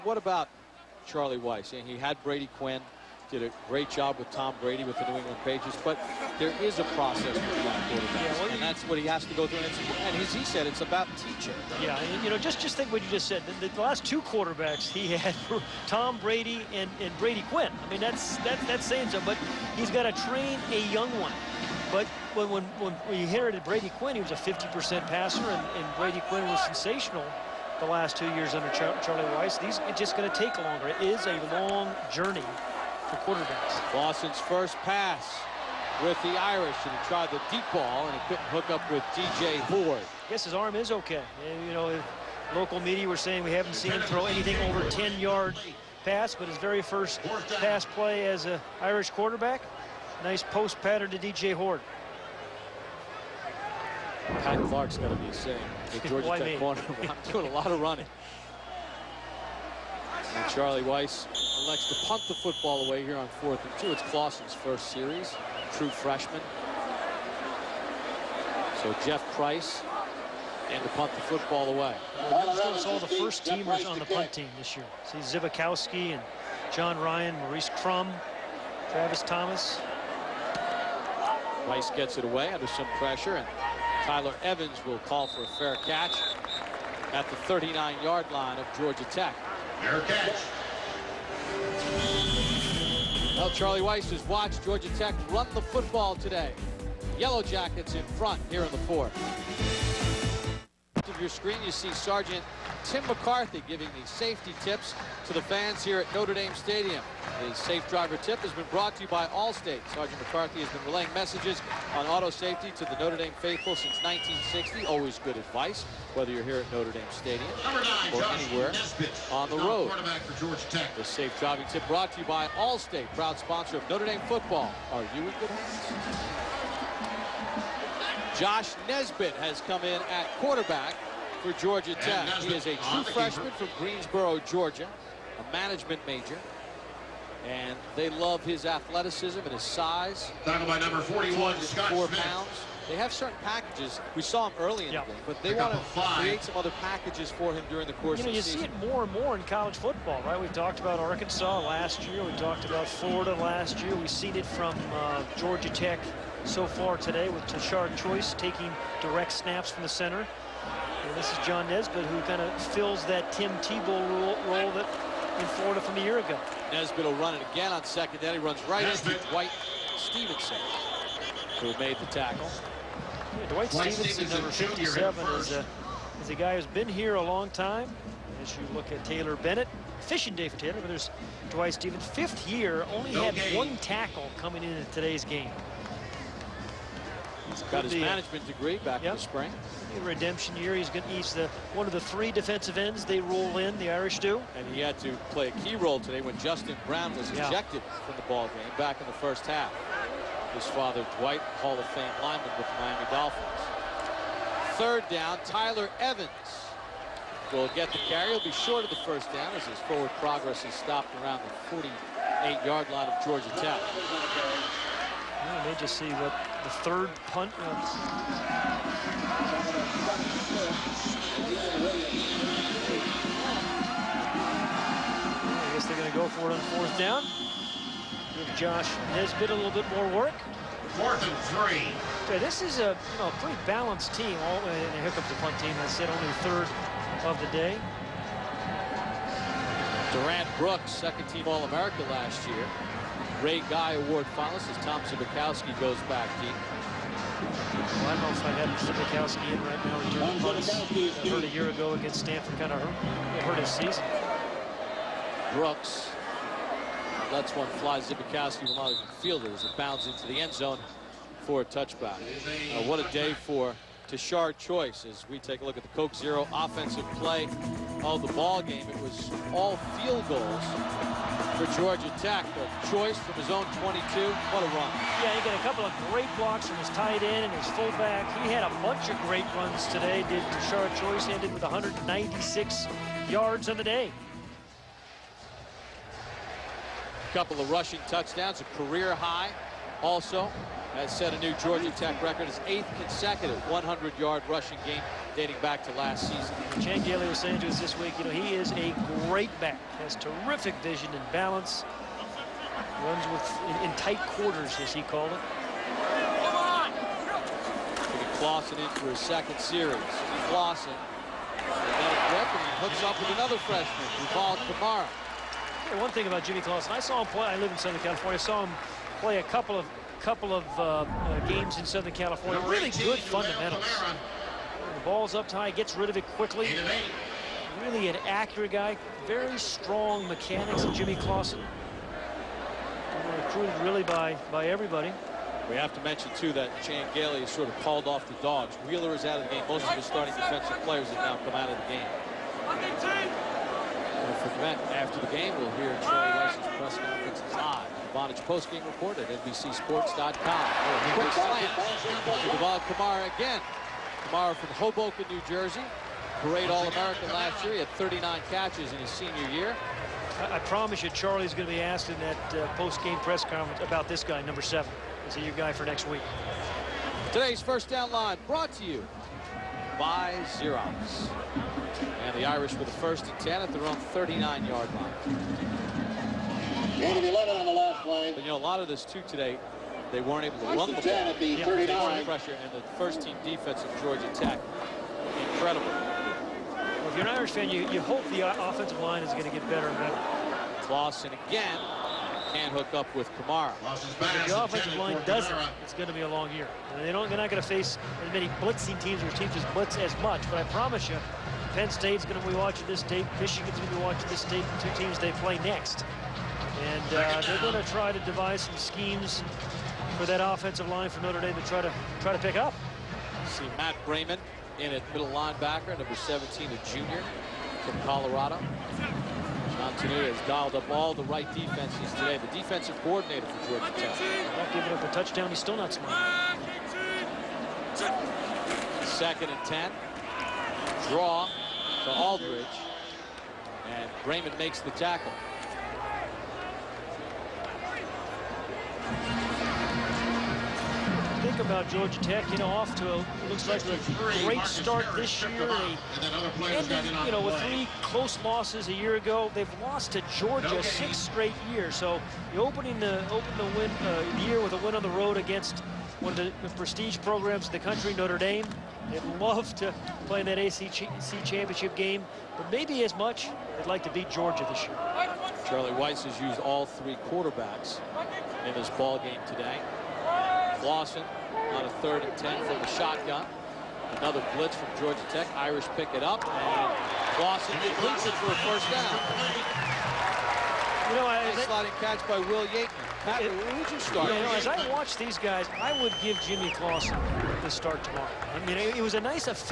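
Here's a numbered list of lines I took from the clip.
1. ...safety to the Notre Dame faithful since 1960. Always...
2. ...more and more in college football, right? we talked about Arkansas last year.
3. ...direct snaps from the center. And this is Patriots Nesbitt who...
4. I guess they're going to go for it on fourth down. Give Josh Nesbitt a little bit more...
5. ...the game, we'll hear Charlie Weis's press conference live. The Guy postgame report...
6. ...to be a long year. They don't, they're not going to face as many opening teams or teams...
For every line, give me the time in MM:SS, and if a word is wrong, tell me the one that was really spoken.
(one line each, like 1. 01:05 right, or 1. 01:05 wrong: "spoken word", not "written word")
1. 01:52 right
2. 02:28 right
3. 02:39 wrong: "Josh", not "Patriots"
4. 03:45 right
5. 05:45 wrong: "Vonage", not "Guy"
6. 06:36 wrong: "blitzing", not "opening".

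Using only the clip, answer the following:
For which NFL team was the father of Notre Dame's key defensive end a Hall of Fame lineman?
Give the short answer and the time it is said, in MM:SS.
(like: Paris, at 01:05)
Miami Dolphins, at 03:22.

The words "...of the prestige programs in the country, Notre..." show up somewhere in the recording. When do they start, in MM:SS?
07:36.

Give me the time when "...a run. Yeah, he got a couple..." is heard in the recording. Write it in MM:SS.
04:34.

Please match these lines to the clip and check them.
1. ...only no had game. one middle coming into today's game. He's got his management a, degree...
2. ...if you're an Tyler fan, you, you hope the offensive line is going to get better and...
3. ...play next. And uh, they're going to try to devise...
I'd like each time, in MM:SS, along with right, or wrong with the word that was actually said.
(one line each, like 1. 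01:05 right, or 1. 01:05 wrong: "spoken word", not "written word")
1. 03:02 wrong: "tackle", not "middle"
2. 06:27 wrong: "Irish", not "Tyler"
3. 06:45 right.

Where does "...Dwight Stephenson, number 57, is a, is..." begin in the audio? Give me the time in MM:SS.
02:53.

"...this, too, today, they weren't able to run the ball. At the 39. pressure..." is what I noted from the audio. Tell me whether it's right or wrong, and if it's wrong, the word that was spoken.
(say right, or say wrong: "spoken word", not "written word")
right.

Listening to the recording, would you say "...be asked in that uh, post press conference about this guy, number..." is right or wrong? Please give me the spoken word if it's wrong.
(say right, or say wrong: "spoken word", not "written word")
right.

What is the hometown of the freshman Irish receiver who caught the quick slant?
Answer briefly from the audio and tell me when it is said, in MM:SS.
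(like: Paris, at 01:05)
Hoboken, New Jersey, at 05:54.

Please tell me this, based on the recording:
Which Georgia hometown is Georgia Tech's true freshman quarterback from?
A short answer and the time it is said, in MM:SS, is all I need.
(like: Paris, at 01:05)
Greensboro, Georgia, at 02:13.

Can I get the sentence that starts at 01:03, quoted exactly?
It's Clausen's first series, true freshman.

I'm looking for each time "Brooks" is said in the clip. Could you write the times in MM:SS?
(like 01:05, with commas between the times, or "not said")
04:00, 04:15.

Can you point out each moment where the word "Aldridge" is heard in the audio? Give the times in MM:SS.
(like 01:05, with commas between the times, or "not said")
07:12.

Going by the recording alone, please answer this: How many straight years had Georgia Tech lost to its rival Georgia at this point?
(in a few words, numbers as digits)
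6.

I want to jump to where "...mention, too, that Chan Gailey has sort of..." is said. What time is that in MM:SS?
05:36.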